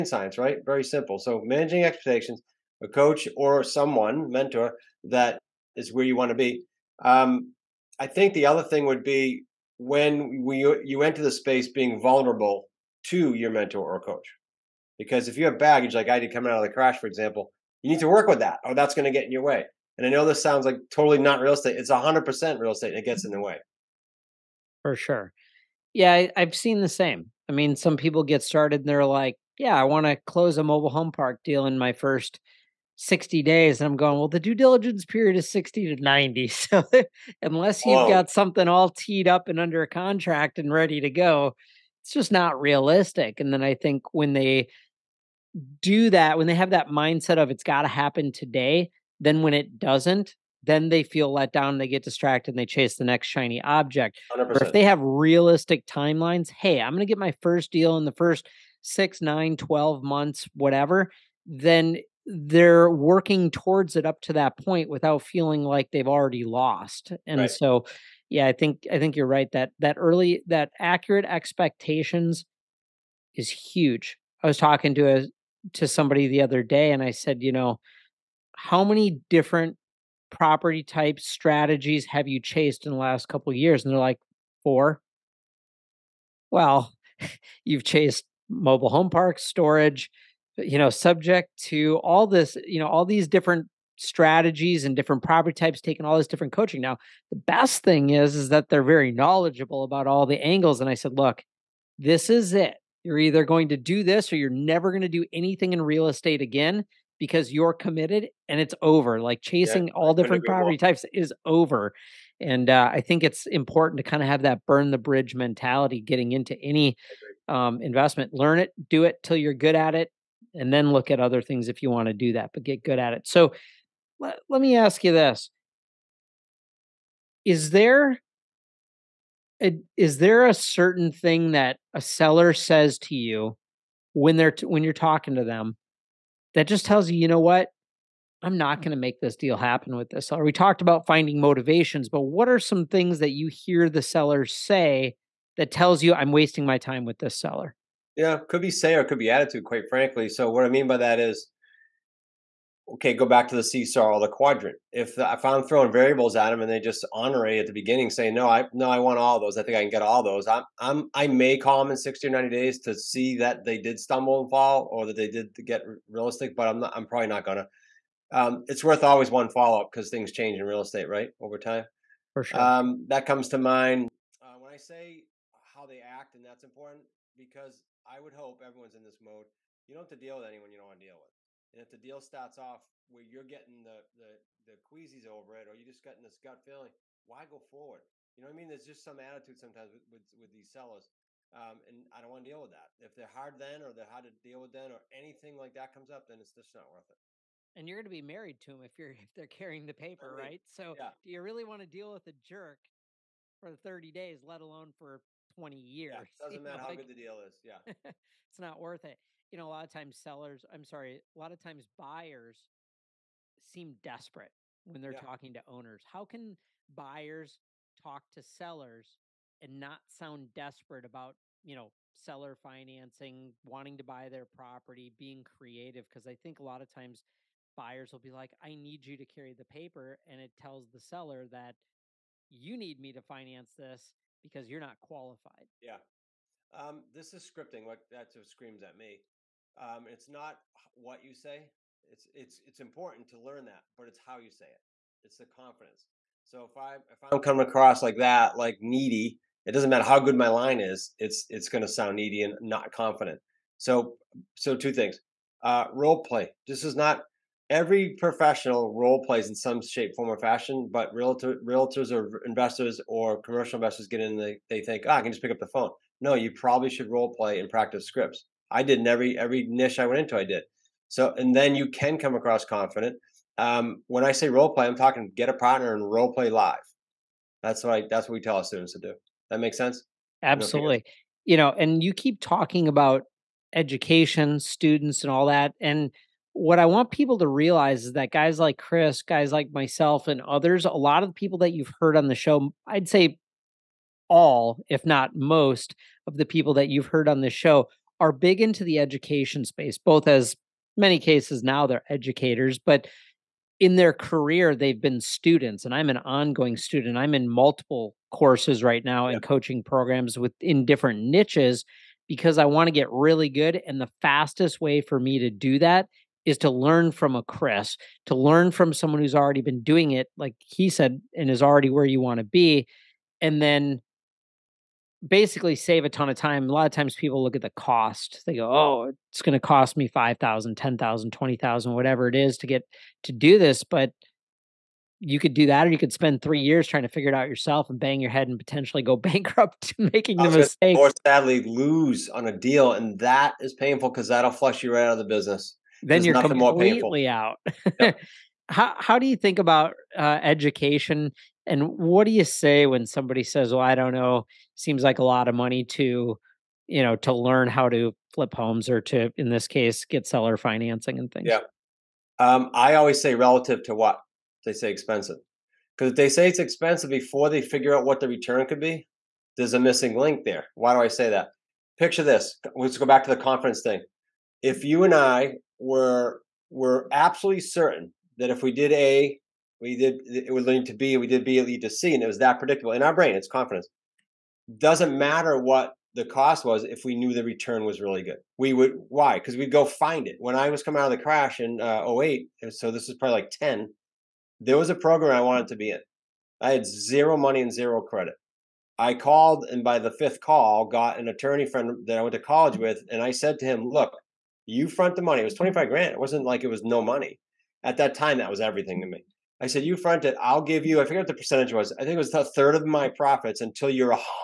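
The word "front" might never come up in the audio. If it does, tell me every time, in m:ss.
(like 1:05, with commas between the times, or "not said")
6:44, 6:49.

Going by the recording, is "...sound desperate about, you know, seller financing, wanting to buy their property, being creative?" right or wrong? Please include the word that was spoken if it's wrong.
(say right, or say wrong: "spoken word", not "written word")
right.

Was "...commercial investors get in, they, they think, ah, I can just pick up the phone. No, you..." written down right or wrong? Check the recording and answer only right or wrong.
right.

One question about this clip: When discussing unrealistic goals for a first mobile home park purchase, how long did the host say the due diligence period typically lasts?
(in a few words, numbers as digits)
60 to 90 days.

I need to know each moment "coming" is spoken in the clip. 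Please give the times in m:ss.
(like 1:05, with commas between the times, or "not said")
0:16, 4:07, 6:30.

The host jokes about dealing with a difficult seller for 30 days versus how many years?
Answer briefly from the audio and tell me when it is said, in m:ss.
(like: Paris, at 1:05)
20 years, at 3:25.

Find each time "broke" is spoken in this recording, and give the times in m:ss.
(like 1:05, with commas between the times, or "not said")
not said.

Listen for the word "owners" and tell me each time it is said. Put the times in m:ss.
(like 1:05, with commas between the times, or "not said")
3:35.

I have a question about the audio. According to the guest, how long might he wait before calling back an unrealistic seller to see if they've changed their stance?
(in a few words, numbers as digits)
60 or 90 days.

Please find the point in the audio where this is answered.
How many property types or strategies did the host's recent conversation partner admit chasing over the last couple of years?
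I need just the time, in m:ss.
1:24.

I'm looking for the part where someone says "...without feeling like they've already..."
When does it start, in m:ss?
1:04.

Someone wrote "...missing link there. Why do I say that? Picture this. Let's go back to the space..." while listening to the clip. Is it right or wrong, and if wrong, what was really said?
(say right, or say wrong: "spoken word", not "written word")
wrong: "conference", not "space".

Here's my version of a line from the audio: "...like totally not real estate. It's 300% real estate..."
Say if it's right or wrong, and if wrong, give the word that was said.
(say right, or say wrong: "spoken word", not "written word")
wrong: "100", not "300".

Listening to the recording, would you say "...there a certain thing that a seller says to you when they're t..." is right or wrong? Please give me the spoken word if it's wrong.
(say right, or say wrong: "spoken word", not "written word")
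right.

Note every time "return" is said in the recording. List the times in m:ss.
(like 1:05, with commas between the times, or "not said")
6:08, 6:27.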